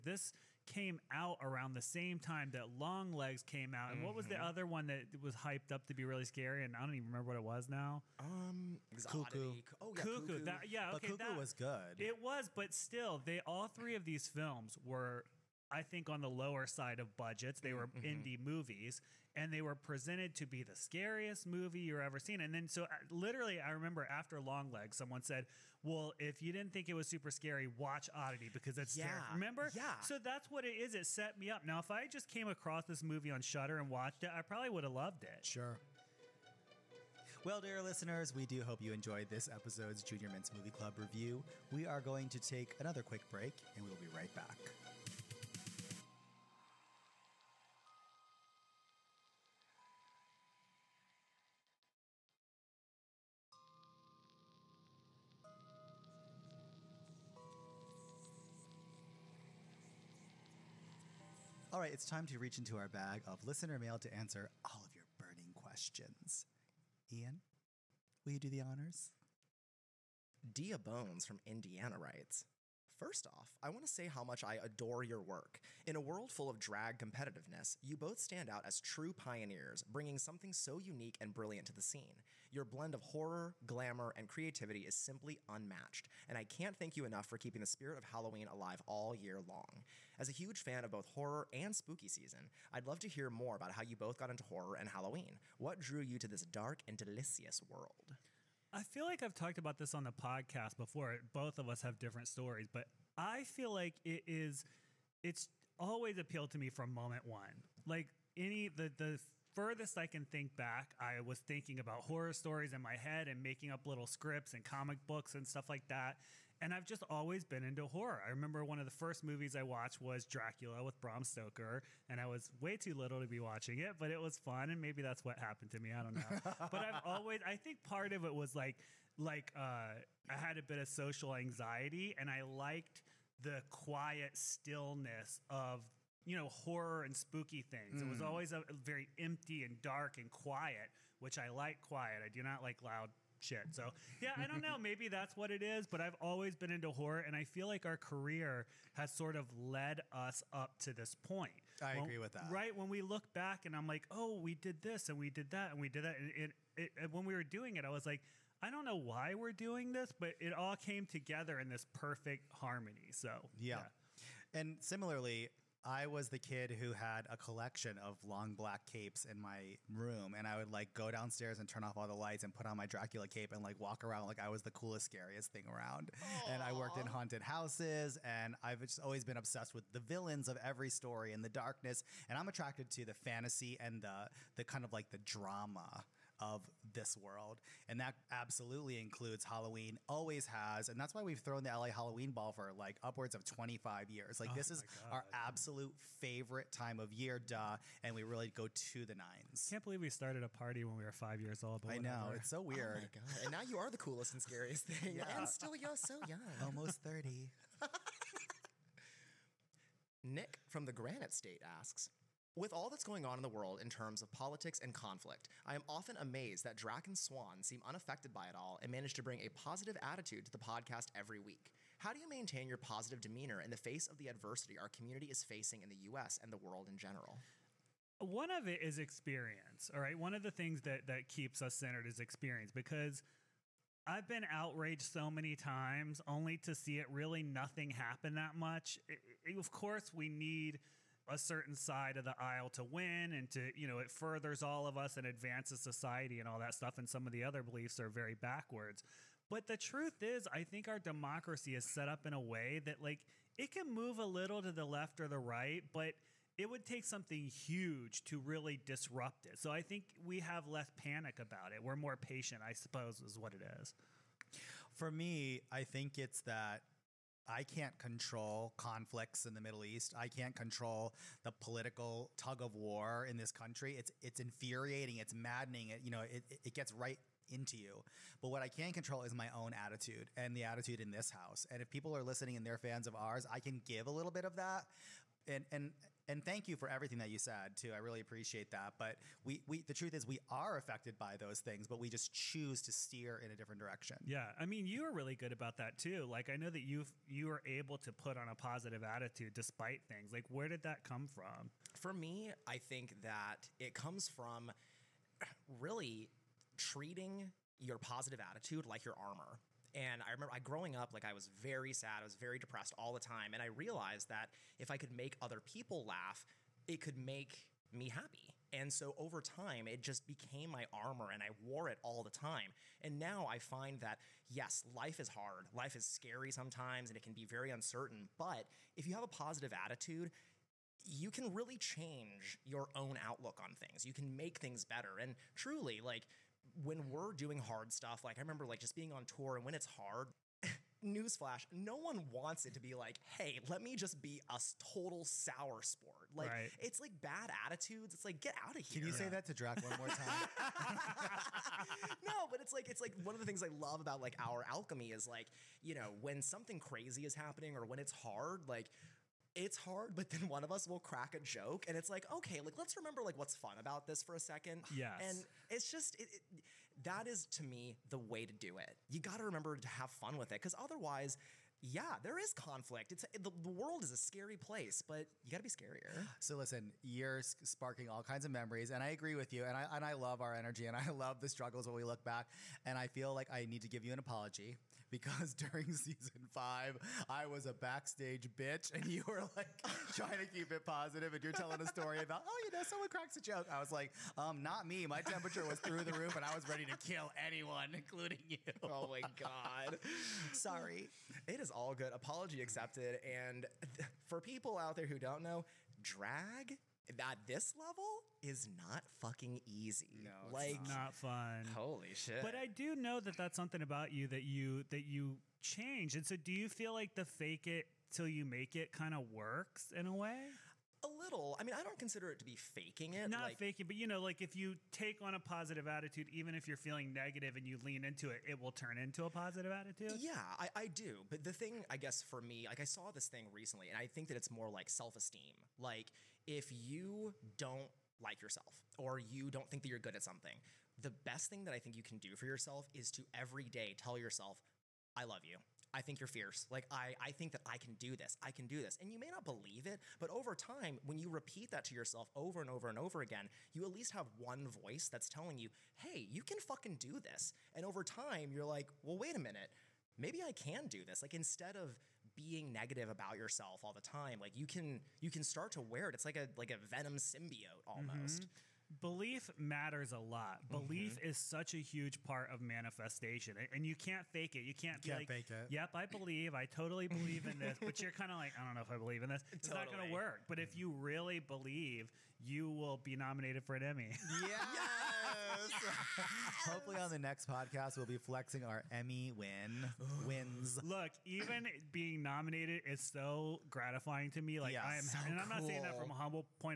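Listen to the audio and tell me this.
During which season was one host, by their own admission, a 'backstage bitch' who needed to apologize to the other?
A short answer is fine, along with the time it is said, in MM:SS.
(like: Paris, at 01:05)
season 5, at 06:25.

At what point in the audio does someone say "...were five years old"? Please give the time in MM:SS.
03:21.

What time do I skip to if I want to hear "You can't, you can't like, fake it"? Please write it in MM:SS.
07:54.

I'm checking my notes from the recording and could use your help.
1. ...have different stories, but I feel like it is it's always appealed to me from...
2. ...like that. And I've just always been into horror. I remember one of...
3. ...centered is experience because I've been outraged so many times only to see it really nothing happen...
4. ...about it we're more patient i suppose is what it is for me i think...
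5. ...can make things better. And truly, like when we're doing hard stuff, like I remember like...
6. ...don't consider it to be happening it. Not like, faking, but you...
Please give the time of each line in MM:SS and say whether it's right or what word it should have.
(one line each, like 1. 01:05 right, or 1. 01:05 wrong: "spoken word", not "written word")
1. 01:41 right
2. 01:55 right
3. 03:51 right
4. 04:21 right
5. 05:34 right
6. 07:01 wrong: "faking", not "happening".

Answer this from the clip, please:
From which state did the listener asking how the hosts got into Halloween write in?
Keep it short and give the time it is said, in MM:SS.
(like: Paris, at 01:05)
Indiana, at 01:11.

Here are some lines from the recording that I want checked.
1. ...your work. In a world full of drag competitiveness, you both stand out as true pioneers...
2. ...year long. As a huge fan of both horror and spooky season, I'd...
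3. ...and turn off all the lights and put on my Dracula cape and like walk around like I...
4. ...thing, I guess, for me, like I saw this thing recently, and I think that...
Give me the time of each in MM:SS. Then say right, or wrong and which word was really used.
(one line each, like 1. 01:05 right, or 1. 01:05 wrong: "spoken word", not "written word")
1. 01:15 right
2. 01:29 right
3. 02:51 right
4. 07:11 right.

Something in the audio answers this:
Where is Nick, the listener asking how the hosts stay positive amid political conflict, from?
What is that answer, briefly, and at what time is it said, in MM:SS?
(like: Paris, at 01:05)
the Granite State, at 03:30.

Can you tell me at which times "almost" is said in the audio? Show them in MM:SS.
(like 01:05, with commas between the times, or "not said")
03:26, 07:47.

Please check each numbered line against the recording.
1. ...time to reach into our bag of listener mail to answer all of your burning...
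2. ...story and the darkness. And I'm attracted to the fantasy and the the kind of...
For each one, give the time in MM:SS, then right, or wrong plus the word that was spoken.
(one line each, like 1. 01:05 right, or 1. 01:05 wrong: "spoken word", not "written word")
1. 01:02 right
2. 03:00 right.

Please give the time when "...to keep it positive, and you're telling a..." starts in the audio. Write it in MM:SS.
06:30.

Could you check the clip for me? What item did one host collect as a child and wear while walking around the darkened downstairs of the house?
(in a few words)
long black capes.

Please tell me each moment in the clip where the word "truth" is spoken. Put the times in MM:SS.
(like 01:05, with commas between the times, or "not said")
04:09, 04:49.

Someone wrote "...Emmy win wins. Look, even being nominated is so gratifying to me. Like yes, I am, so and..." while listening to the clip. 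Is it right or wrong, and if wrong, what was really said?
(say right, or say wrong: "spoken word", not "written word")
right.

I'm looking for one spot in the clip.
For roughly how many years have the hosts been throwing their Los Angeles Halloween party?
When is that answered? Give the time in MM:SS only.
03:13.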